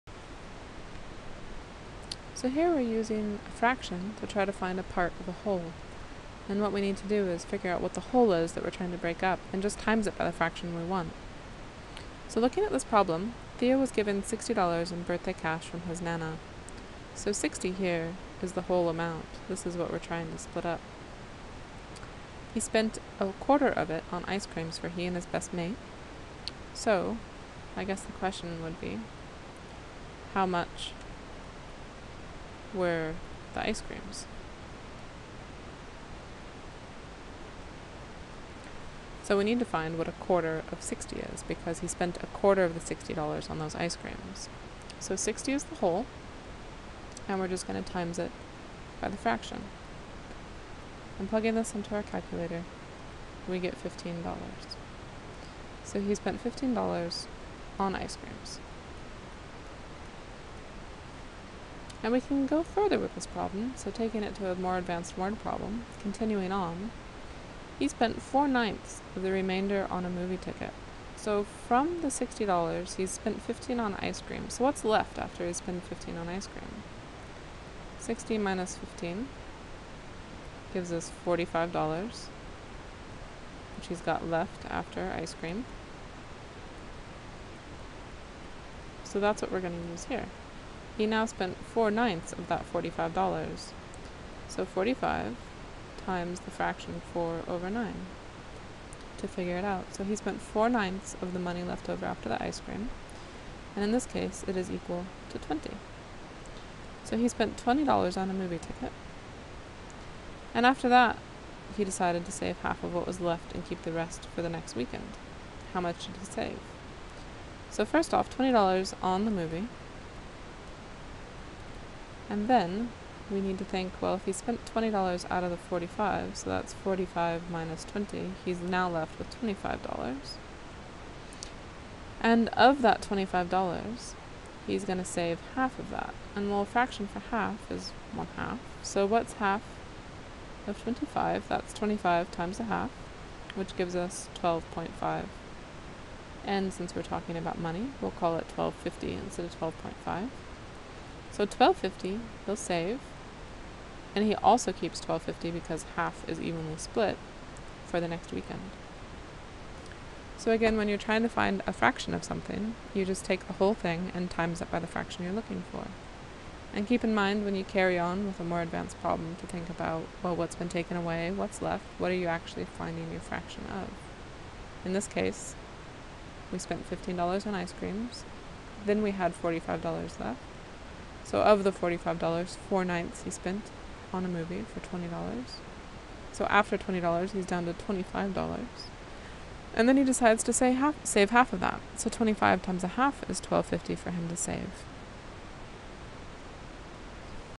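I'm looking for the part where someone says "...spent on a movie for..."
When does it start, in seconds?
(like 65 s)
183 s.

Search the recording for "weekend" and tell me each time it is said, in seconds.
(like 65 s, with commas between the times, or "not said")
114 s, 158 s.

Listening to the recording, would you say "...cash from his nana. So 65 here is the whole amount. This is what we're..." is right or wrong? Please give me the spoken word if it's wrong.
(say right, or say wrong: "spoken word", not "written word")
wrong: "60", not "65".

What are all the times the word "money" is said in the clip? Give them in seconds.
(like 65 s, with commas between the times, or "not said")
101 s, 147 s.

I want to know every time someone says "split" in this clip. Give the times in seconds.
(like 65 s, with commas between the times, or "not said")
20 s, 156 s.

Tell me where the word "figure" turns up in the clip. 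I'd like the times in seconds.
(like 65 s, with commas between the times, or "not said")
7 s, 99 s.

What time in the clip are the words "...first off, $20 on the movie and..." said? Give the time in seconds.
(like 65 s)
117 s.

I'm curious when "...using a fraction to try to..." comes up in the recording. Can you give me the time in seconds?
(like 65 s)
2 s.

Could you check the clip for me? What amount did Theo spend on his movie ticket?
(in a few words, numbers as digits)
$20.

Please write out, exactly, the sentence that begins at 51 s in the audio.
And plugging this into our calculator, we get $15.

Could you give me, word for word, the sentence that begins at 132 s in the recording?
And of that $25, he's going to save half of that.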